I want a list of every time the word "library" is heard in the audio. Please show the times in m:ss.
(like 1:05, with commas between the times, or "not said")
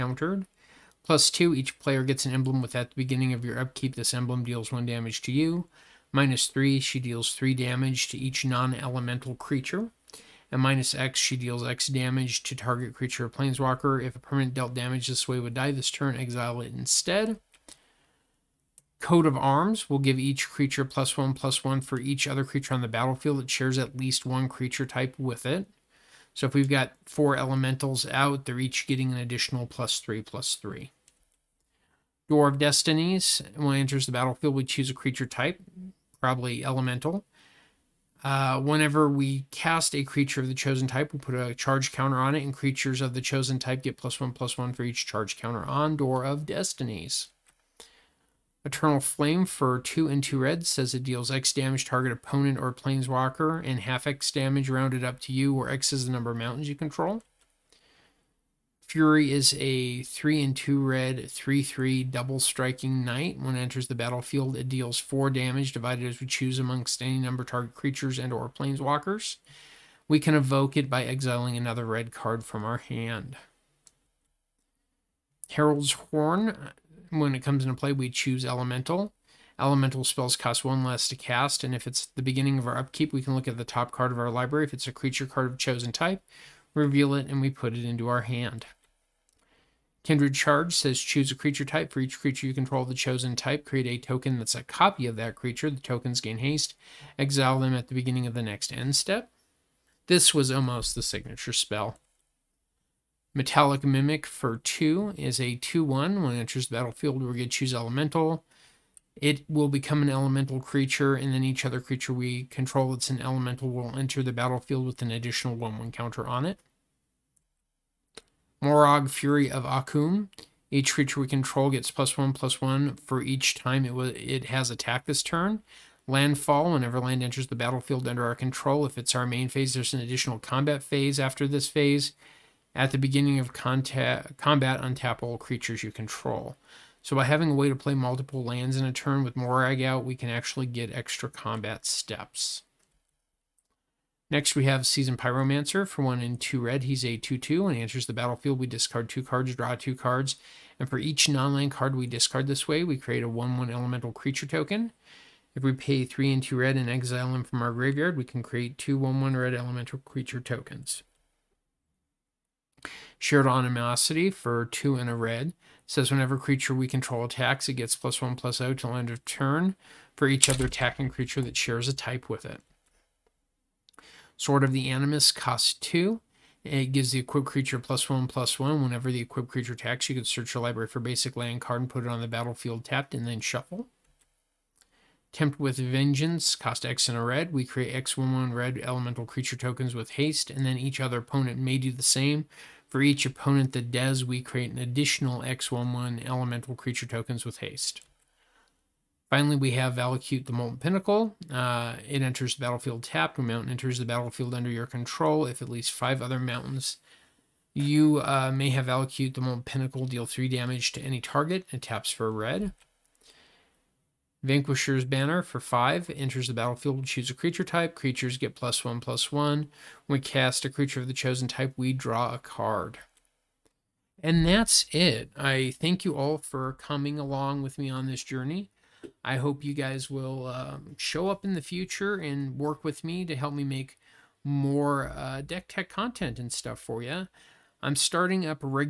1:24, 3:00.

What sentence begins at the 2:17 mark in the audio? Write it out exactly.
So by having a way to play multiple lands in a turn with Moraug out, we can actually get extra combat steps.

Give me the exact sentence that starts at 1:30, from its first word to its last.
Kindred Charge says choose a creature type.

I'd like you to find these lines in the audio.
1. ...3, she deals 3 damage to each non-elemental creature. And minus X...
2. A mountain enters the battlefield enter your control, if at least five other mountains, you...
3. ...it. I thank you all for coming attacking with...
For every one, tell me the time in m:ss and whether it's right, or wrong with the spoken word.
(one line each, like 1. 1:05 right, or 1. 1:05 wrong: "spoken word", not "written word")
1. 0:06 right
2. 3:23 wrong: "under", not "enter"
3. 3:44 wrong: "along", not "attacking".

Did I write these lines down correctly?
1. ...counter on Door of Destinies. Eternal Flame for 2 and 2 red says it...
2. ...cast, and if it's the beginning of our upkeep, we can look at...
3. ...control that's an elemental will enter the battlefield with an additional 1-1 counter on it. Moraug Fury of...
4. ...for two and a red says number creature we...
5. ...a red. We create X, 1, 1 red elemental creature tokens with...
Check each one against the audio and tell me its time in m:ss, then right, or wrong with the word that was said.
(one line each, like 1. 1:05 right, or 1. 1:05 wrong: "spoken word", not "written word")
1. 0:45 right
2. 1:21 right
3. 1:52 right
4. 2:44 wrong: "whenever", not "number"
5. 3:07 right.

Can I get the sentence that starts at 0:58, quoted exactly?
Fury is a 3 and 2 red 3 3 double striking knight.